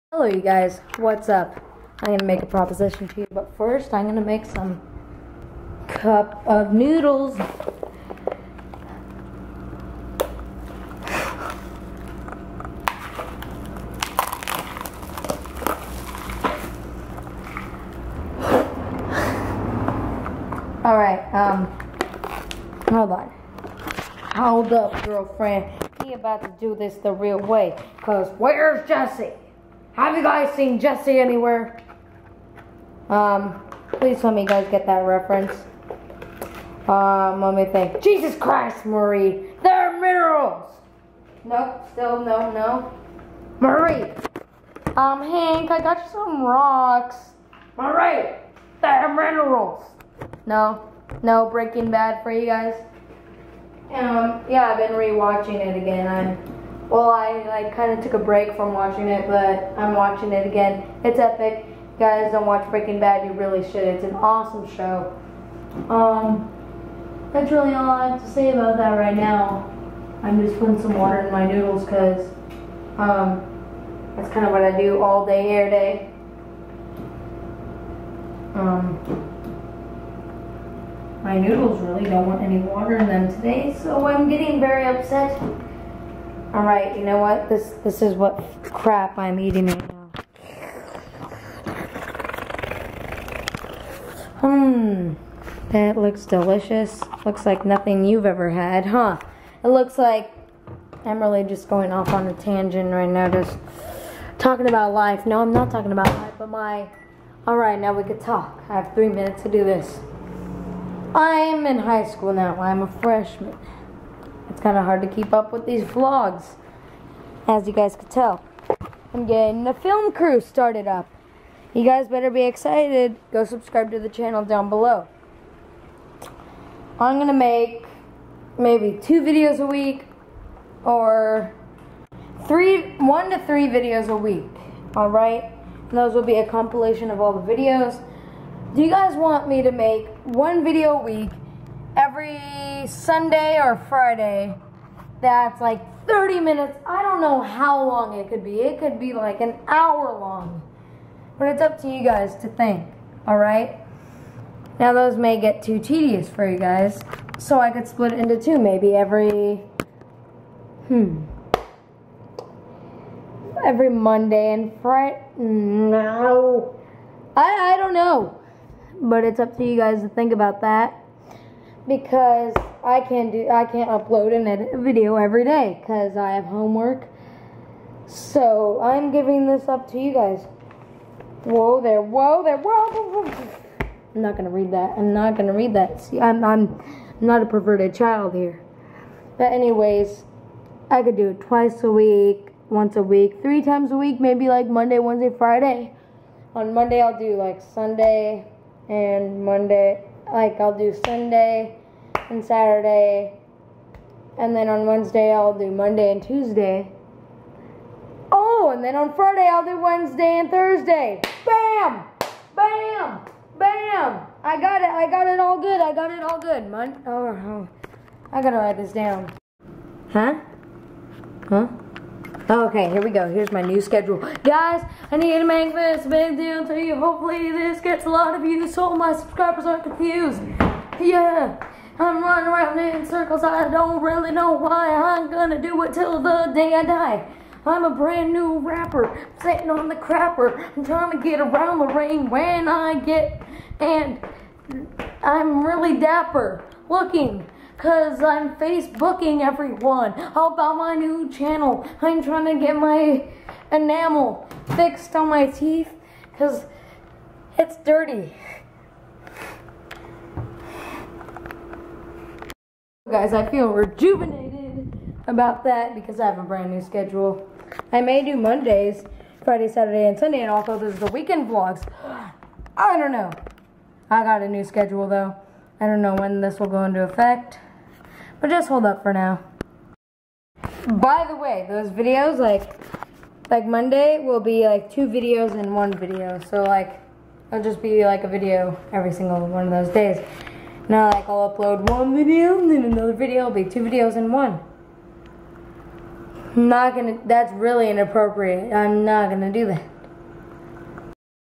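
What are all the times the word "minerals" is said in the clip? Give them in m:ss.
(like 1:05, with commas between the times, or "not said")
0:39, 0:49.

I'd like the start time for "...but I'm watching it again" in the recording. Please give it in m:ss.
0:59.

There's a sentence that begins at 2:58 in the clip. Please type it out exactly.
So I'm giving this up to you guys.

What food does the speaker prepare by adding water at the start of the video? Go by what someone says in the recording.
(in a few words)
cup of noodles.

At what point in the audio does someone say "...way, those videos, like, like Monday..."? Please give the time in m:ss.
4:41.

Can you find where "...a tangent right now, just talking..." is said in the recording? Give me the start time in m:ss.
1:42.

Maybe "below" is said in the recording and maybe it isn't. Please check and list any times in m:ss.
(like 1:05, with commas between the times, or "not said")
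2:04.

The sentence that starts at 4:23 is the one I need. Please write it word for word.
Guys, I feel rejuvenated about that because I have a brand new schedule.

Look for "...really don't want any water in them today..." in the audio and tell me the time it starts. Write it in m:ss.
1:21.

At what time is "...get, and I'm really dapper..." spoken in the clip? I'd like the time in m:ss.
4:02.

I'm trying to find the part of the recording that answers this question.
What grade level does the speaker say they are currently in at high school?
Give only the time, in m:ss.
1:52.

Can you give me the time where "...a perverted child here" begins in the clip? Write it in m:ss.
3:07.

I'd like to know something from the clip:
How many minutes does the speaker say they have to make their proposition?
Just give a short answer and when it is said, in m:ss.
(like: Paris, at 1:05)
3, at 1:48.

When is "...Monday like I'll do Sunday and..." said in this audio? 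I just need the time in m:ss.
3:19.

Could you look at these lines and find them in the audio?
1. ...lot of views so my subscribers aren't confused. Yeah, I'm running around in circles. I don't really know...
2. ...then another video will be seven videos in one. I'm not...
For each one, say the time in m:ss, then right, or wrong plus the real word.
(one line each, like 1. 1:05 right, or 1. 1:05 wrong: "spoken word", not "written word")
1. 3:48 right
2. 4:52 wrong: "two", not "seven".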